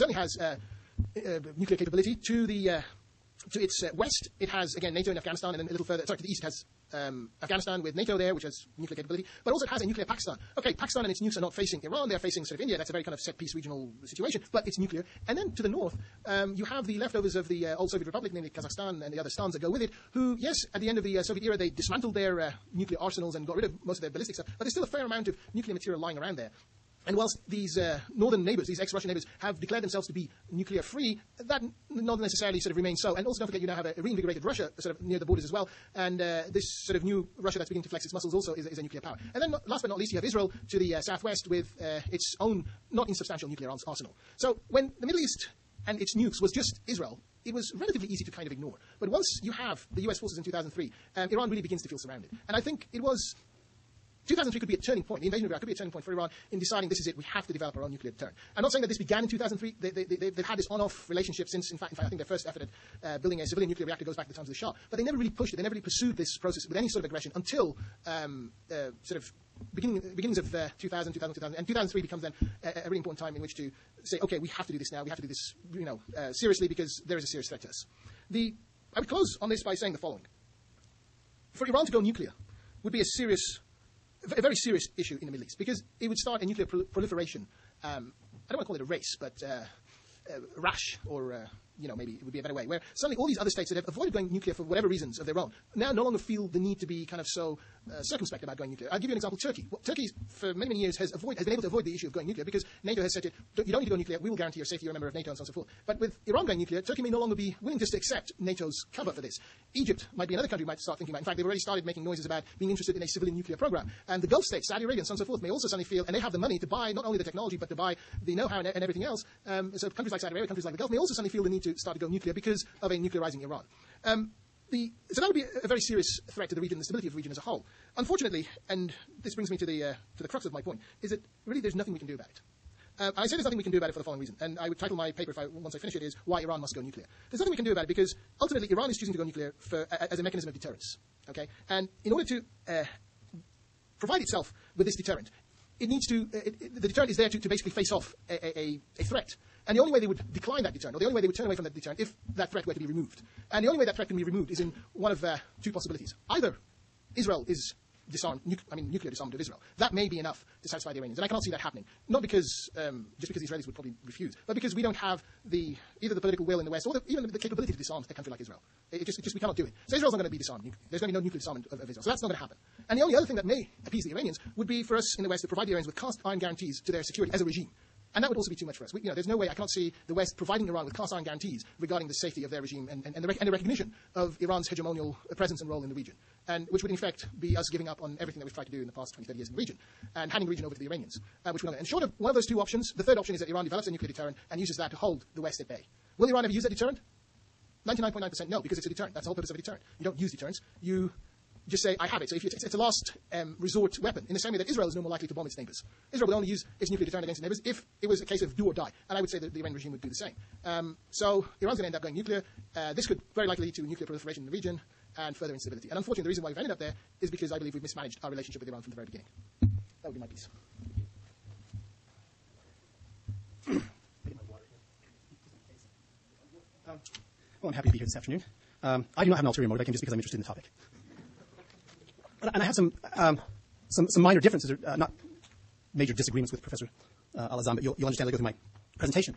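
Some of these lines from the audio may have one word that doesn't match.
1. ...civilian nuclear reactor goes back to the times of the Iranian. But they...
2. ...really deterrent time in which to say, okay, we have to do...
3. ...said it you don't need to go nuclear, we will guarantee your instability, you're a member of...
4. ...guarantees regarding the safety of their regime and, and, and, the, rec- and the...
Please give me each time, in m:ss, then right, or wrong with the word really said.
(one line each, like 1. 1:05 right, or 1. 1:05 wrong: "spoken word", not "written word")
1. 1:03 wrong: "Shah", not "Iranian"
2. 1:12 wrong: "important", not "deterrent"
3. 1:43 wrong: "safety", not "instability"
4. 3:01 right.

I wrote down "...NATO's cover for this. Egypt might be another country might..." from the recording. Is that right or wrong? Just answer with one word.
right.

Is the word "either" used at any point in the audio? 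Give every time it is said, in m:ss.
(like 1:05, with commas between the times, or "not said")
2:36, 2:46.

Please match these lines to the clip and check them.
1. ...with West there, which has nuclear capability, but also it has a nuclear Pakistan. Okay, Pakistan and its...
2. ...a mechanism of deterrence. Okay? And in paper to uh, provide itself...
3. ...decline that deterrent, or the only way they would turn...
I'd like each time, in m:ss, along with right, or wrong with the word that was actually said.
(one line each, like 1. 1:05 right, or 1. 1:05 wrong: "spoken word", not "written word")
1. 0:07 wrong: "NATO", not "West"
2. 2:20 wrong: "order", not "paper"
3. 2:30 right.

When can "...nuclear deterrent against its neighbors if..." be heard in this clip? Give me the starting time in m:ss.
3:26.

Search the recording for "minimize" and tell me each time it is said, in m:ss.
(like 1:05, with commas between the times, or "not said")
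not said.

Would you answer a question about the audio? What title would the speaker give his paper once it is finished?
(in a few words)
Why Iran Must Go Nuclear.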